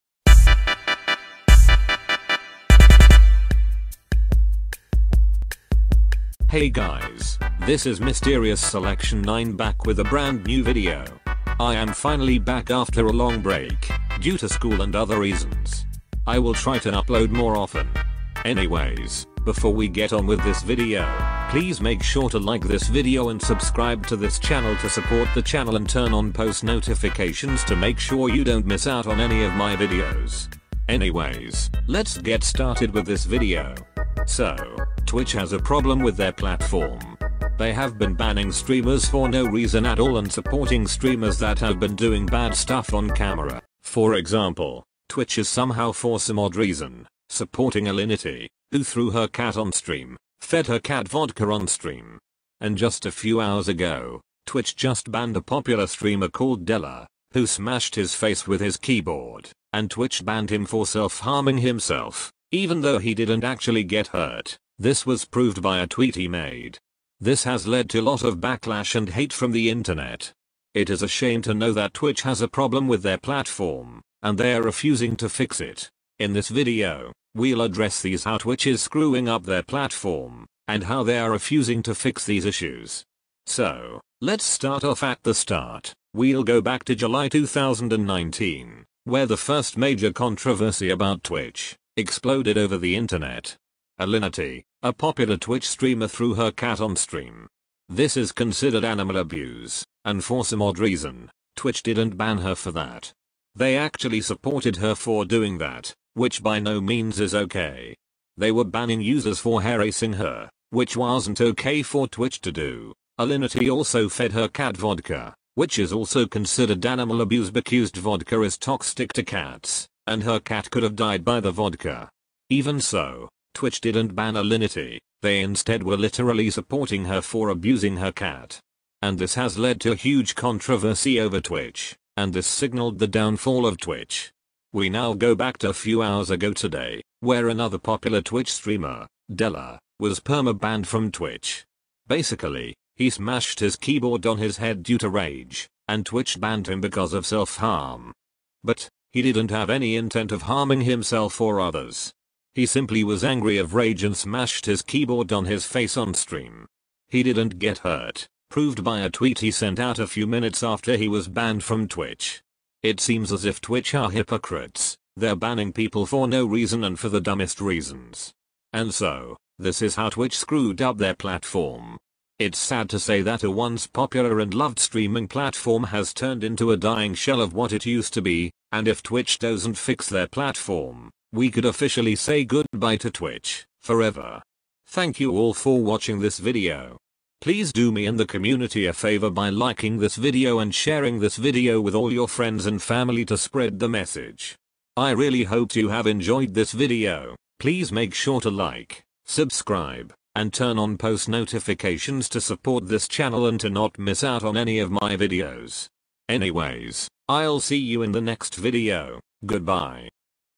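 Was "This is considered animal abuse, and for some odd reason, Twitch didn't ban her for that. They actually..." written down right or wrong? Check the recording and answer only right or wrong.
right.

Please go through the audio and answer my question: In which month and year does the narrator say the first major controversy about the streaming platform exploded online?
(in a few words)
July 2019.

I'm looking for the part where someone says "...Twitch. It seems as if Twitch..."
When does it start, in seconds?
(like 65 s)
161 s.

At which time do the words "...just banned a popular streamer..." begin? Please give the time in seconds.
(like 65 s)
54 s.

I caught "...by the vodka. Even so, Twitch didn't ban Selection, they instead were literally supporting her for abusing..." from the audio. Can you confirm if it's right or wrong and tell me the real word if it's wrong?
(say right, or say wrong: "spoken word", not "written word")
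wrong: "Alinity", not "Selection".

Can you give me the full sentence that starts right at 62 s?
Even though he didn't actually get hurt, this was proved by a tweet he made.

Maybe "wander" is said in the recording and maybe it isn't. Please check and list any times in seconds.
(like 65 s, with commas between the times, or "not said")
not said.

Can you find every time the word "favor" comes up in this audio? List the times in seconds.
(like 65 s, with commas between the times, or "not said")
188 s.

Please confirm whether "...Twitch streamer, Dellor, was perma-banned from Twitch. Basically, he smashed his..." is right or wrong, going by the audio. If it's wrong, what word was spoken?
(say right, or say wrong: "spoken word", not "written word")
right.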